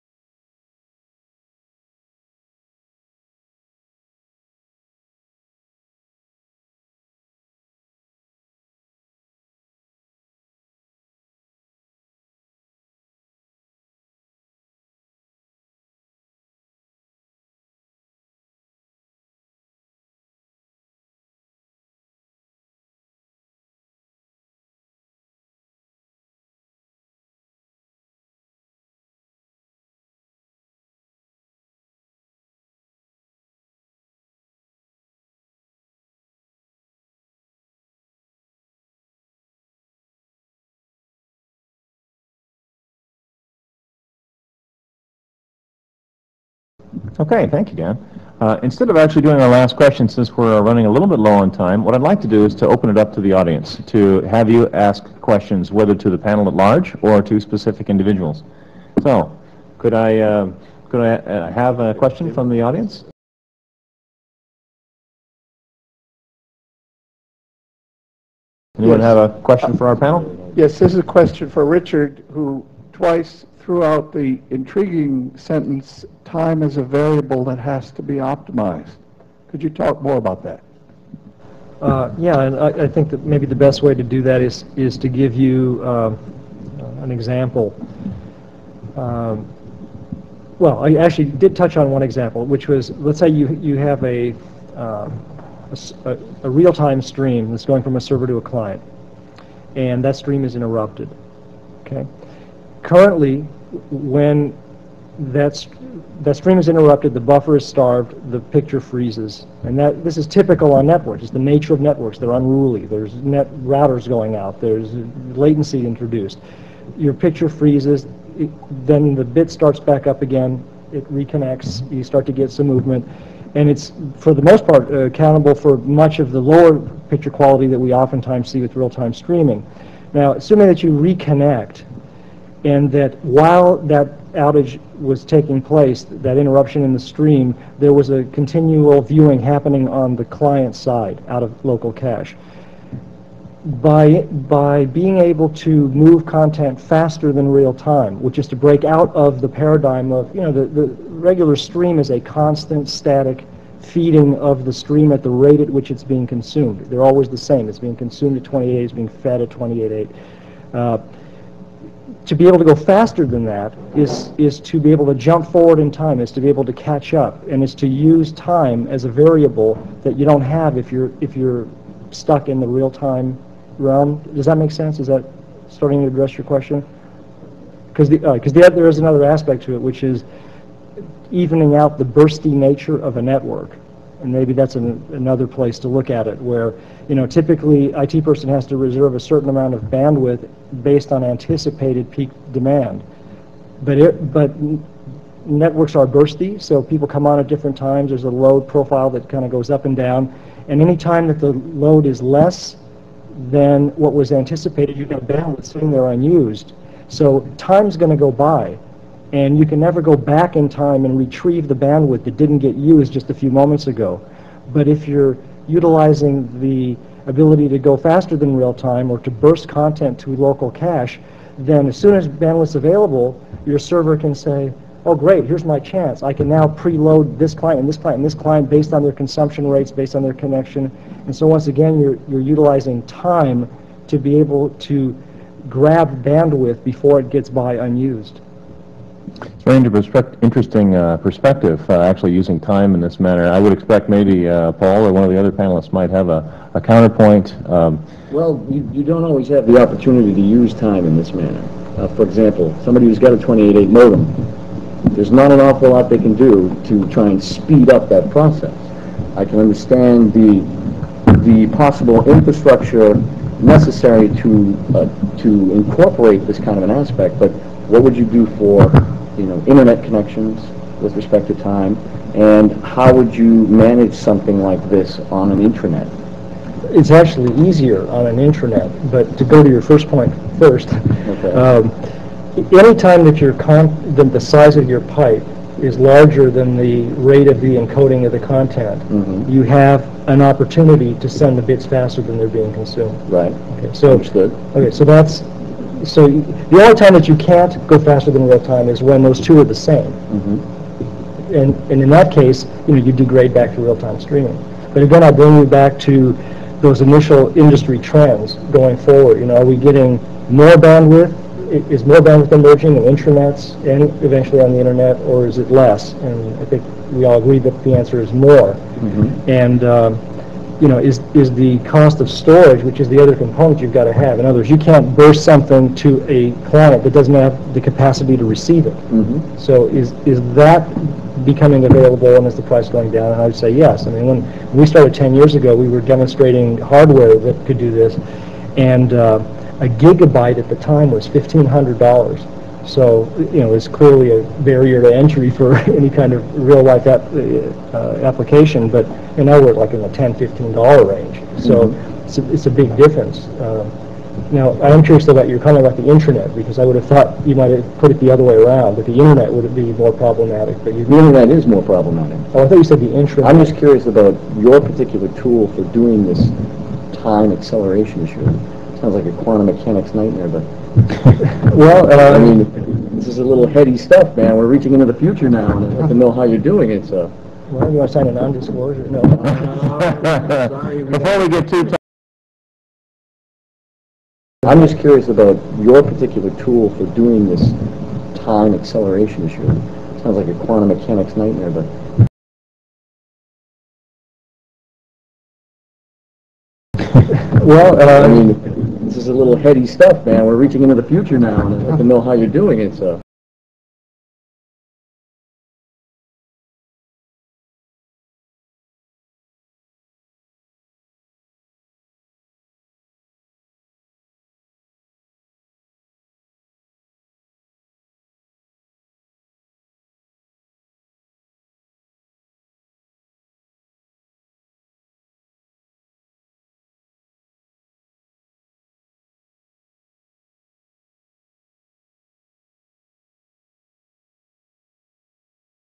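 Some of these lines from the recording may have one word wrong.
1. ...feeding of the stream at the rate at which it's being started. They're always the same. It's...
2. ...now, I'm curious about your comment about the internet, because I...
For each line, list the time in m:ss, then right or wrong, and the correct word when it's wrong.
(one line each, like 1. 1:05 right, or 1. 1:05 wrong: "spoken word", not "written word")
1. 2:33 wrong: "consumed", not "started"
2. 5:54 right.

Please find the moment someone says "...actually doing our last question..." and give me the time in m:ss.
0:48.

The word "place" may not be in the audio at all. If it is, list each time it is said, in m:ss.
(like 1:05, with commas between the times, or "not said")
2:15, 3:05.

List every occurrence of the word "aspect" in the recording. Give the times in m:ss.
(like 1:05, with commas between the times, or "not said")
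2:59, 4:26.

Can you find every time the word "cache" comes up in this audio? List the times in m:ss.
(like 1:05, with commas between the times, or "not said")
2:21, 3:40.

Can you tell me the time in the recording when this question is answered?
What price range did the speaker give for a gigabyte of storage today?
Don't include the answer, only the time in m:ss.
5:50.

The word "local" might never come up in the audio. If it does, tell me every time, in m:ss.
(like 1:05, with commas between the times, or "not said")
2:21, 3:40.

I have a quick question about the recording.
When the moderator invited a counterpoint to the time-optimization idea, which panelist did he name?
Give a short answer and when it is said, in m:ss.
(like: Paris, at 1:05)
Paul, at 4:04.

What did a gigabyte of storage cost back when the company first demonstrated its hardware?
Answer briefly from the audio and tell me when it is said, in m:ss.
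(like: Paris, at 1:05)
$1,500, at 5:41.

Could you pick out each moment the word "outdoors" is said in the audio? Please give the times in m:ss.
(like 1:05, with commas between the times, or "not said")
not said.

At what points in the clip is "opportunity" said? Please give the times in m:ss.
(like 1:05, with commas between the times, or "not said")
4:09, 4:50.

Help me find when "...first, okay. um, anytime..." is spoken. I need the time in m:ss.
4:40.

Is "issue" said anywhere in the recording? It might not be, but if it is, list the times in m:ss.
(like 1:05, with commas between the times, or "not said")
6:08, 6:29.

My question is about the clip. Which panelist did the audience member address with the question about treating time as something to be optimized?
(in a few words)
Richard.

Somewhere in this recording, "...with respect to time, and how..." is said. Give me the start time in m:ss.
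4:31.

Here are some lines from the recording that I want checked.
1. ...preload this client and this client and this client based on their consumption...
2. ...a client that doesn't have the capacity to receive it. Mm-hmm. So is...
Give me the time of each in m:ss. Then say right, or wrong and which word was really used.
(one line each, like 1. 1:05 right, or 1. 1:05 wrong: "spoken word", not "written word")
1. 3:46 right
2. 5:26 right.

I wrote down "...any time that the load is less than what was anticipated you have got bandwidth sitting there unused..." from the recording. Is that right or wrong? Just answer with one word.
right.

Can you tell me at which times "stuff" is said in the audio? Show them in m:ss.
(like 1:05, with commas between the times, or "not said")
6:13, 6:39.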